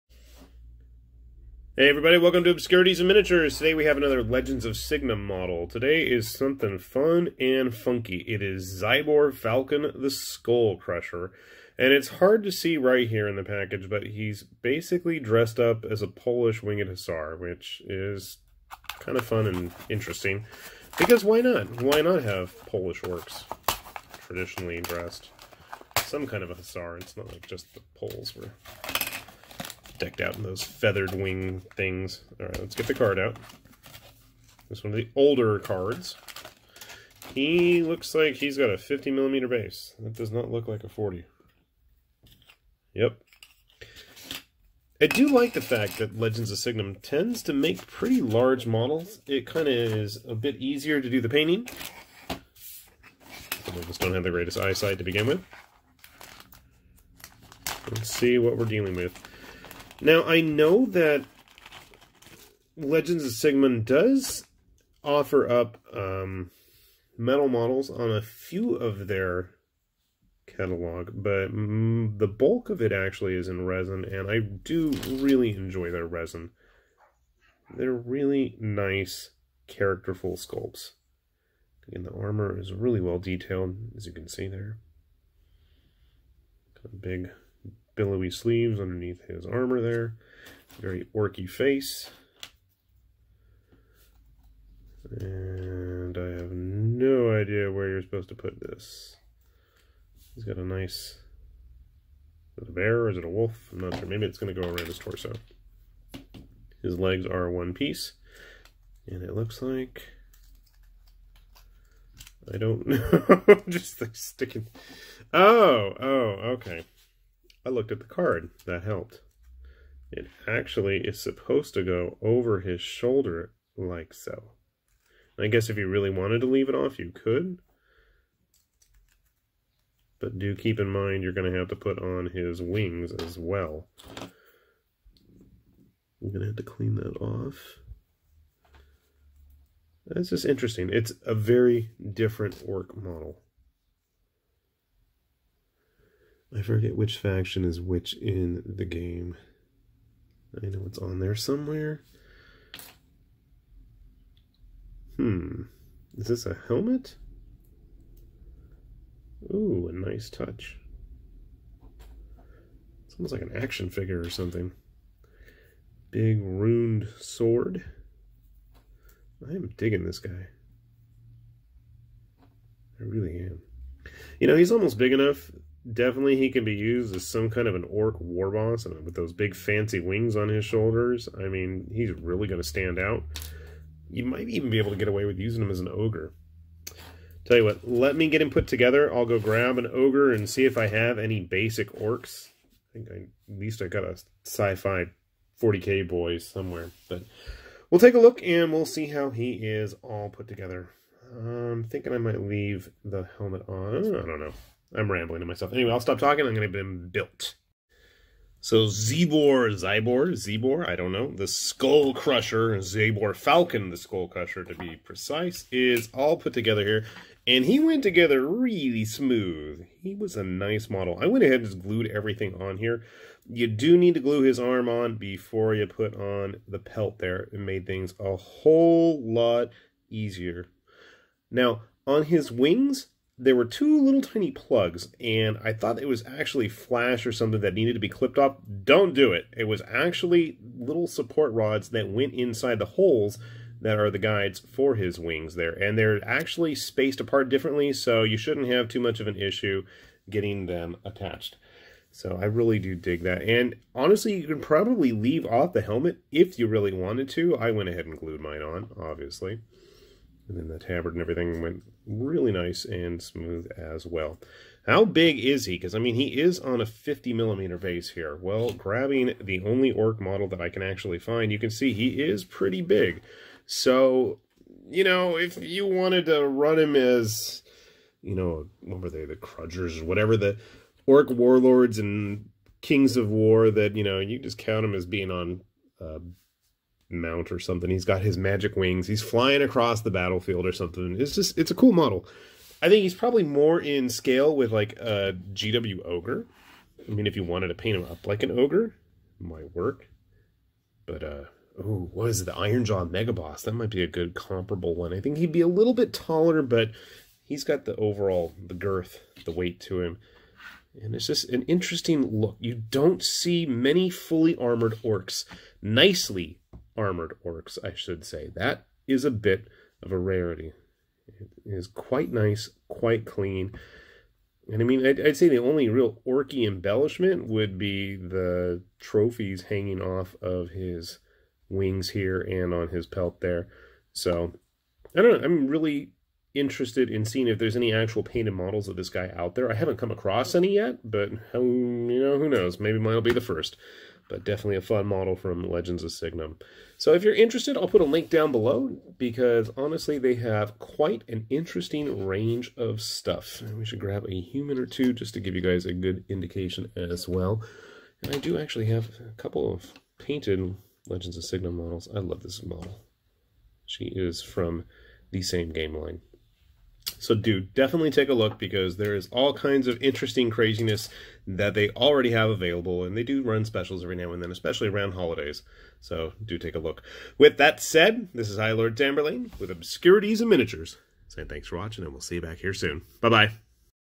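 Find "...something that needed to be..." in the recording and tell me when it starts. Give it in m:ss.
3:57.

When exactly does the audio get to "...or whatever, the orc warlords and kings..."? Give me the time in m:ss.
4:40.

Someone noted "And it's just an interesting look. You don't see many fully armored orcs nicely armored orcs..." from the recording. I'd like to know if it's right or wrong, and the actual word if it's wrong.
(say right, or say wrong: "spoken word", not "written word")
right.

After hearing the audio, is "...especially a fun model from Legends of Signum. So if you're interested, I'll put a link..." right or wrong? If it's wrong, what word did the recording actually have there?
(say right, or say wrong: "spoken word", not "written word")
wrong: "definitely", not "especially".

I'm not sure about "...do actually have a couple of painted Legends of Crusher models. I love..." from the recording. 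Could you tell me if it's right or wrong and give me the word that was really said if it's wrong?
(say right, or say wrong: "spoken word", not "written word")
wrong: "Signum", not "Crusher".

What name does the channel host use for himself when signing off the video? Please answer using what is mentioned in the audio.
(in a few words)
High Lord Tamberlane.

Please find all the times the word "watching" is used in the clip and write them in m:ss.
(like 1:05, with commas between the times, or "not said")
6:21.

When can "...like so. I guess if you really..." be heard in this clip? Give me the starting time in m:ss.
2:03.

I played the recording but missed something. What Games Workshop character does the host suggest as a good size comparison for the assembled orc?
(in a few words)
Iron Jaw Megaboss.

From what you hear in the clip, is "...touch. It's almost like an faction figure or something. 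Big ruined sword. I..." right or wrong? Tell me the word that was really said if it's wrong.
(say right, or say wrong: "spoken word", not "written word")
wrong: "action", not "faction".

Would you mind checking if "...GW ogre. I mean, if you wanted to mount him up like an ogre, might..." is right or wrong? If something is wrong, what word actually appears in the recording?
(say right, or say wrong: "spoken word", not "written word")
wrong: "paint", not "mount".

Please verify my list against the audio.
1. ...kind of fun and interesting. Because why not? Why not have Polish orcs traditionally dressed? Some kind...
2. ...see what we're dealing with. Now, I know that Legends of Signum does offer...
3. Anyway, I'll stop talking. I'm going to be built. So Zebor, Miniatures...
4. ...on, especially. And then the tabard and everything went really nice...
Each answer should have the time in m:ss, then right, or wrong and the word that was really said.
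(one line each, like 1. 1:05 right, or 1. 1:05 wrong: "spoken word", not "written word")
1. 0:18 right
2. 0:58 right
3. 3:25 wrong: "Zibor", not "Miniatures"
4. 4:18 wrong: "obviously", not "especially".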